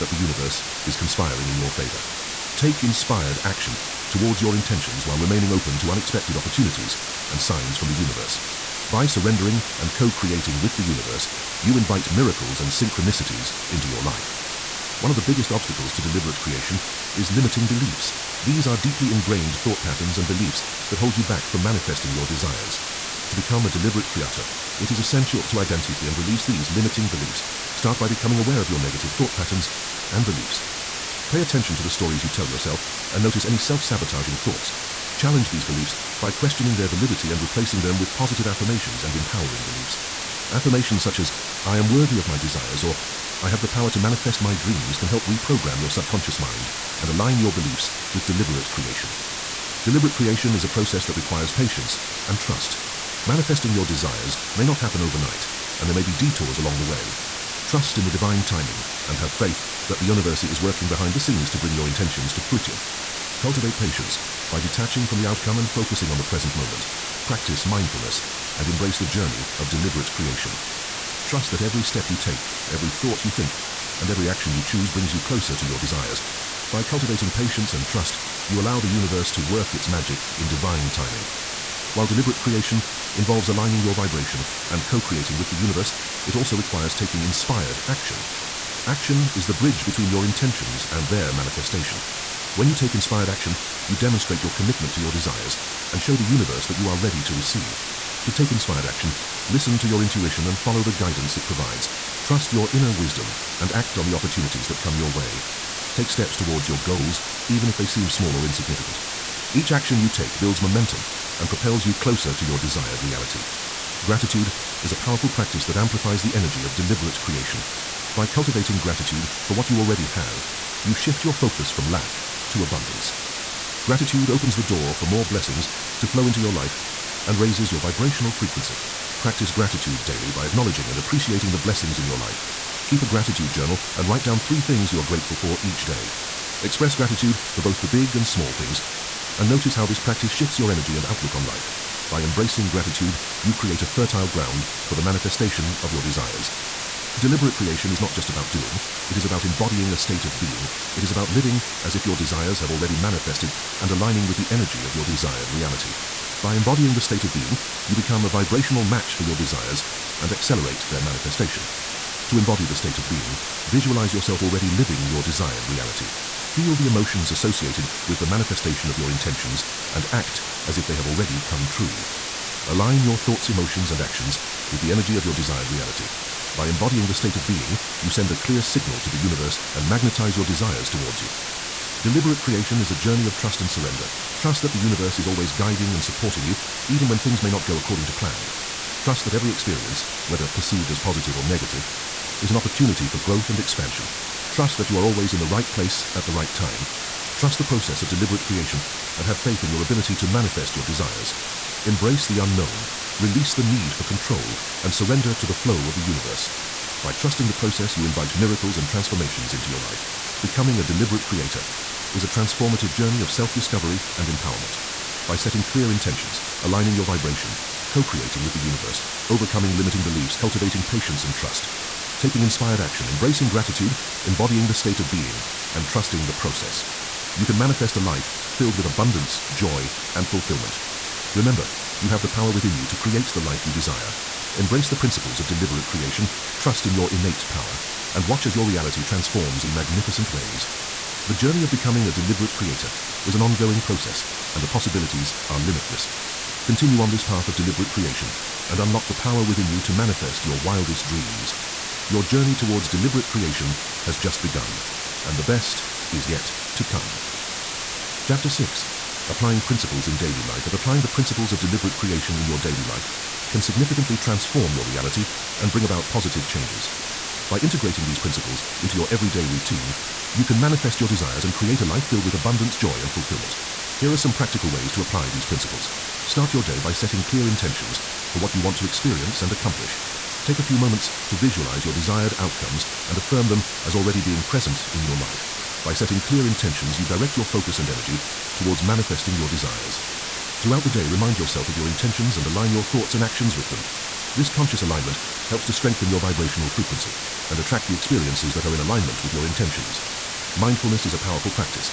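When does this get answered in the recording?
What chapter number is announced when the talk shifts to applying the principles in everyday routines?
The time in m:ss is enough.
4:18.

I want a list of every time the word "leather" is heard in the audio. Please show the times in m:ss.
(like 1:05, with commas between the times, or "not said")
not said.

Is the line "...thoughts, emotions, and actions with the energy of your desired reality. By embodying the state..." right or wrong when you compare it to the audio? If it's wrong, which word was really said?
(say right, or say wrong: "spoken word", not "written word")
right.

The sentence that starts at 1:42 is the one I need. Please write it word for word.
Trust your inner wisdom and act on the opportunities that come your way.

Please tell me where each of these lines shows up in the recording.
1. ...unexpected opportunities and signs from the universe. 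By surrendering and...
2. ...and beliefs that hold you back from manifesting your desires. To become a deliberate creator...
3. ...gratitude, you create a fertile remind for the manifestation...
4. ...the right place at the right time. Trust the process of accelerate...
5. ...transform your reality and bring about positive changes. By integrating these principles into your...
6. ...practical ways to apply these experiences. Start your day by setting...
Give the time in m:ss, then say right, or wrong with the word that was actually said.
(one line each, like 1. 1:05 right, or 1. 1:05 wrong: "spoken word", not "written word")
1. 0:05 right
2. 0:20 right
3. 2:22 wrong: "ground", not "remind"
4. 3:15 wrong: "deliberate", not "accelerate"
5. 4:24 right
6. 4:34 wrong: "principles", not "experiences".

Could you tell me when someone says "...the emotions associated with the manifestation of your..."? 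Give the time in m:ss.
2:46.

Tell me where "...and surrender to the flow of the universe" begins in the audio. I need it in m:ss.
3:24.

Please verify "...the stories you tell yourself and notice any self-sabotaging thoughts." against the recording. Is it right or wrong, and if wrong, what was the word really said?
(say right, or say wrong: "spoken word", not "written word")
right.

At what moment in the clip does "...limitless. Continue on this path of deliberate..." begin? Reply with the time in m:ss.
4:05.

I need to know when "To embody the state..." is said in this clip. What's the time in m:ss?
2:42.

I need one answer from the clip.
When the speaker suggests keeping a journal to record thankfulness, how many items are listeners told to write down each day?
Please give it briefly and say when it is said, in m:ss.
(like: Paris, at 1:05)
3, at 2:14.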